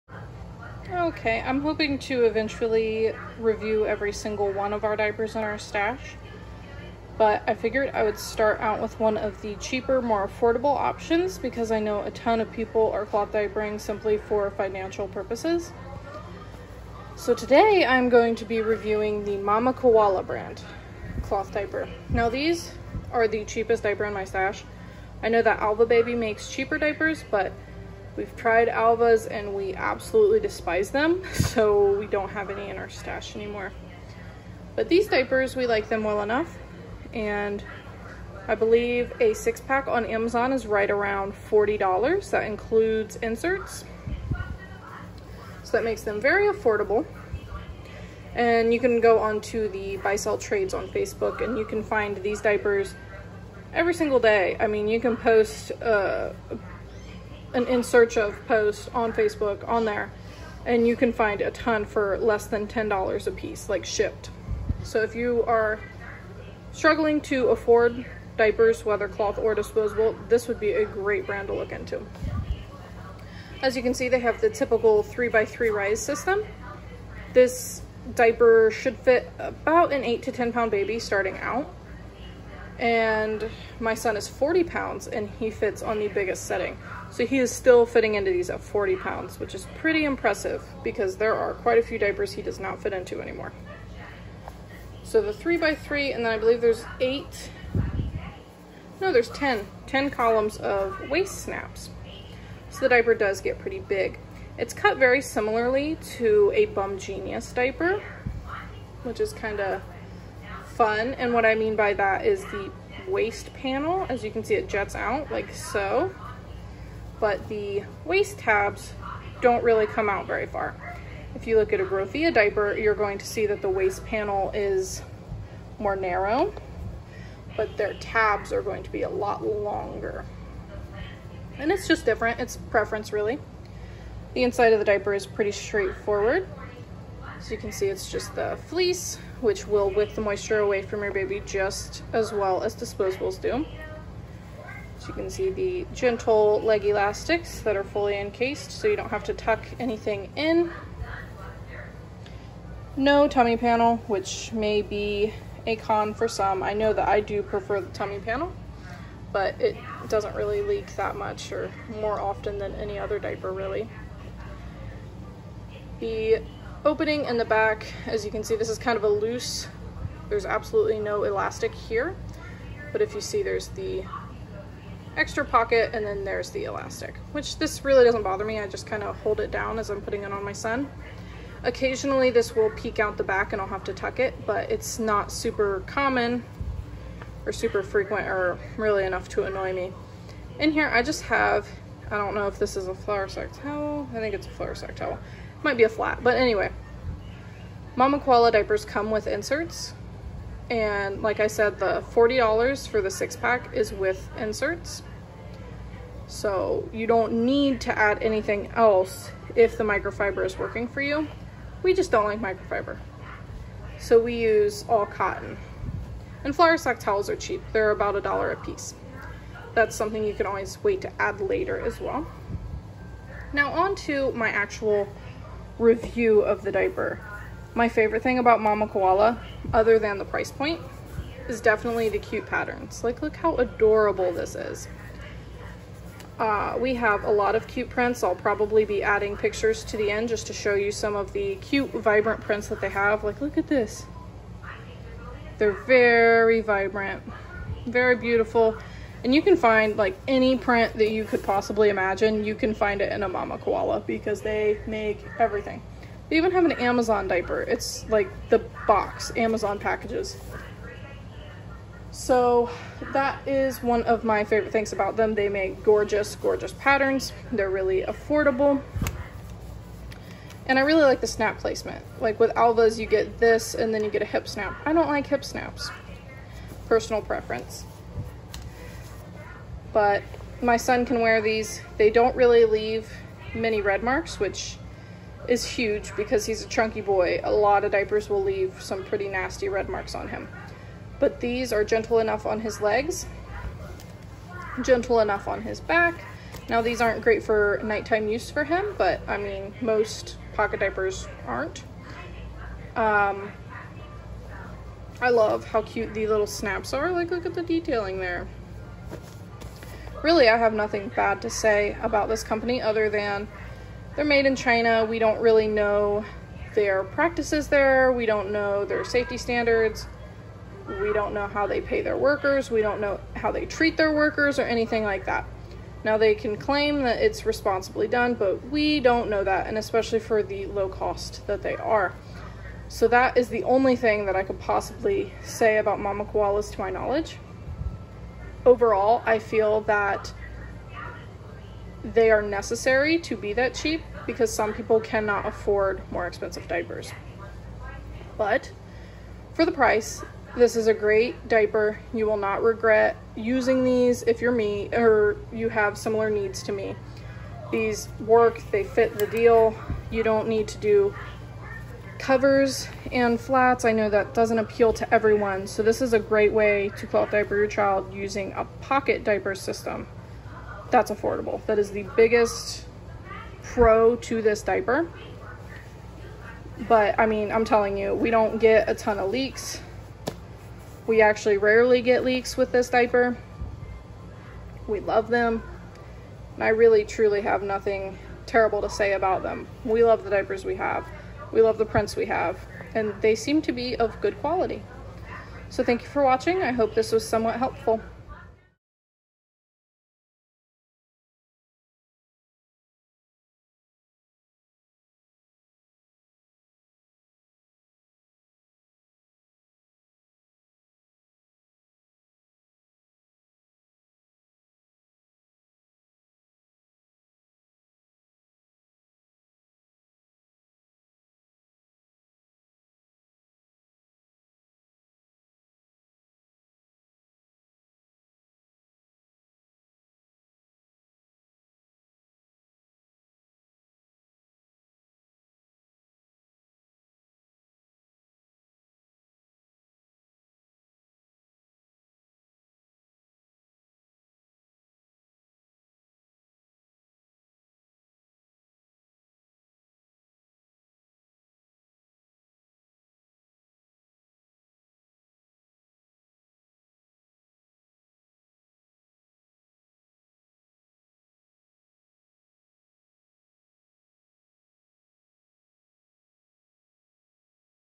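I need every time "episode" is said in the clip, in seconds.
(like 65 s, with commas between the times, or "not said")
not said.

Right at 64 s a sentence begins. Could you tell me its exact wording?
So if you are struggling to afford diapers, whether cloth or disposable, this would be a great brand to look into.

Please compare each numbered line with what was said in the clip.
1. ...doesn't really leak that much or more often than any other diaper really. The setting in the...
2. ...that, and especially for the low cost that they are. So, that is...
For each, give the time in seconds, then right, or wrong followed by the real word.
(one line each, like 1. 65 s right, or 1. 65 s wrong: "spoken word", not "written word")
1. 160 s wrong: "opening", not "setting"
2. 329 s right.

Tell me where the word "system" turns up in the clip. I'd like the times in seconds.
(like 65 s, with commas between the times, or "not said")
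75 s, 369 s.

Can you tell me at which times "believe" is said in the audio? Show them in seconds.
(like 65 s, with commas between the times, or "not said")
38 s, 96 s.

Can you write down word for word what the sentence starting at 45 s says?
So that makes them very affordable.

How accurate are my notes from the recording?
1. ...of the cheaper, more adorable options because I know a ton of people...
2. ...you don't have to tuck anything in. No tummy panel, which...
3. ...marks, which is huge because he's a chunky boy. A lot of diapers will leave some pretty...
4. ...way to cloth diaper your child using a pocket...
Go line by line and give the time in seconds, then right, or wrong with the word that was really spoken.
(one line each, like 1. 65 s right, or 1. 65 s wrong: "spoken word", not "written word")
1. 9 s wrong: "affordable", not "adorable"
2. 148 s right
3. 284 s right
4. 366 s right.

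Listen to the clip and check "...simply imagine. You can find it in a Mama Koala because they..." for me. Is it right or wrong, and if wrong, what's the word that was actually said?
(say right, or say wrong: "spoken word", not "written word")
wrong: "possibly", not "simply".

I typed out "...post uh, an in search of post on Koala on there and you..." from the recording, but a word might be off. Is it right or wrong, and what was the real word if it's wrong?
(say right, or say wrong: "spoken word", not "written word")
wrong: "Facebook", not "Koala".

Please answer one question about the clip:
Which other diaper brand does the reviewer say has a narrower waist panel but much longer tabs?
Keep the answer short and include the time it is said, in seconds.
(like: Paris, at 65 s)
GroVia, at 121 s.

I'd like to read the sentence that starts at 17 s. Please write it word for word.
So today I'm going to be reviewing the Mama Koala brand cloth diaper.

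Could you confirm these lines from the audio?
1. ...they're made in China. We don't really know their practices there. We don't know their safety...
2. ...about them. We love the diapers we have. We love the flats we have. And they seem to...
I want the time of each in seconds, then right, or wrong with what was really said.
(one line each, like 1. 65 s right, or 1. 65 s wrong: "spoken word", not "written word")
1. 314 s right
2. 389 s wrong: "prints", not "flats".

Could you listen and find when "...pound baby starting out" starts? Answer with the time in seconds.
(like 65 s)
80 s.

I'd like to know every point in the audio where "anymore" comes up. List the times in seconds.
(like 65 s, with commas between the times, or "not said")
33 s, 93 s.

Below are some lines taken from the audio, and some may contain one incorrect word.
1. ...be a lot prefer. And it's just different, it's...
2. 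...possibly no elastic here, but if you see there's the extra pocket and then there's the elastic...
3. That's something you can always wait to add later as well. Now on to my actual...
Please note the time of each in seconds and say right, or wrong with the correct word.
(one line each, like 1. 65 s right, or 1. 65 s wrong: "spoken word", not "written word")
1. 128 s wrong: "longer", not "prefer"
2. 170 s wrong: "absolutely", not "possibly"
3. 219 s right.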